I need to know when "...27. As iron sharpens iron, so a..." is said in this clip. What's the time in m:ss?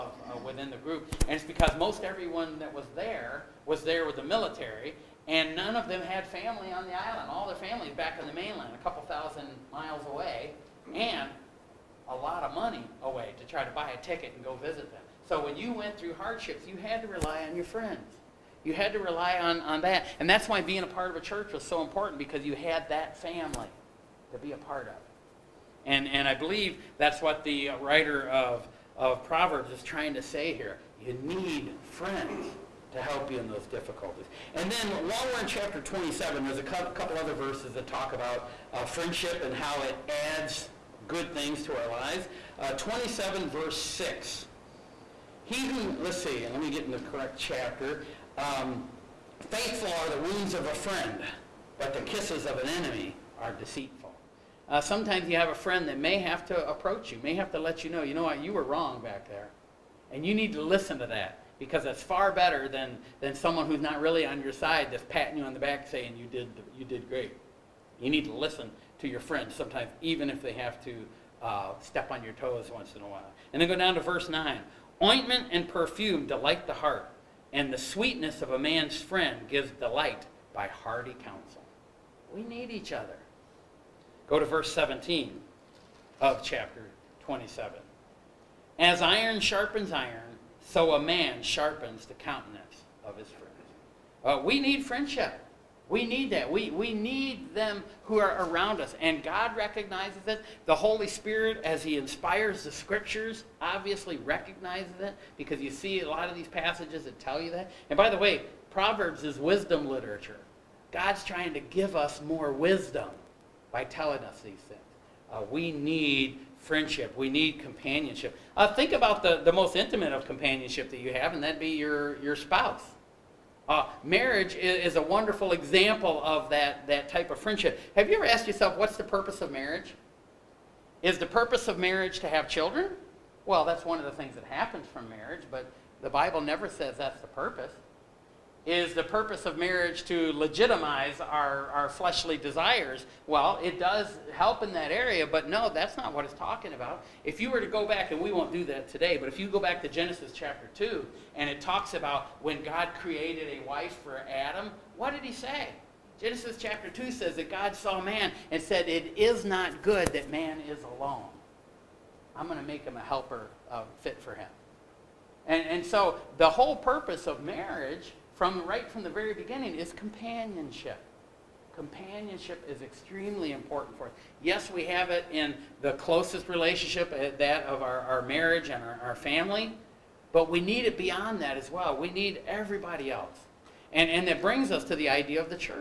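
1:27.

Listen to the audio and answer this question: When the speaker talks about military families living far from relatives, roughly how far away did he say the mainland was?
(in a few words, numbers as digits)
a couple thousand miles.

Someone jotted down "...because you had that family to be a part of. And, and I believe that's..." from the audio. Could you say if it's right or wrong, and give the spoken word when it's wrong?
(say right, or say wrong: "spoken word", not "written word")
right.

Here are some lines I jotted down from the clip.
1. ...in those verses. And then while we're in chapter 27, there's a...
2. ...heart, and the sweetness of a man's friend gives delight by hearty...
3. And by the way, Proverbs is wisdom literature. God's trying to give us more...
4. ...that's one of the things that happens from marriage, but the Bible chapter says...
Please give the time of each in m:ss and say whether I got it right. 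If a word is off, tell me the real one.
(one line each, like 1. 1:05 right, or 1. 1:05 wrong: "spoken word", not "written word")
1. 0:33 wrong: "difficulties", not "verses"
2. 1:16 right
3. 1:47 right
4. 2:13 wrong: "never", not "chapter".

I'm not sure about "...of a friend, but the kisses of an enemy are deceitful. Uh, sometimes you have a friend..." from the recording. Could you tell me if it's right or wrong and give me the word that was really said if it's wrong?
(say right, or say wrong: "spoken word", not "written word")
right.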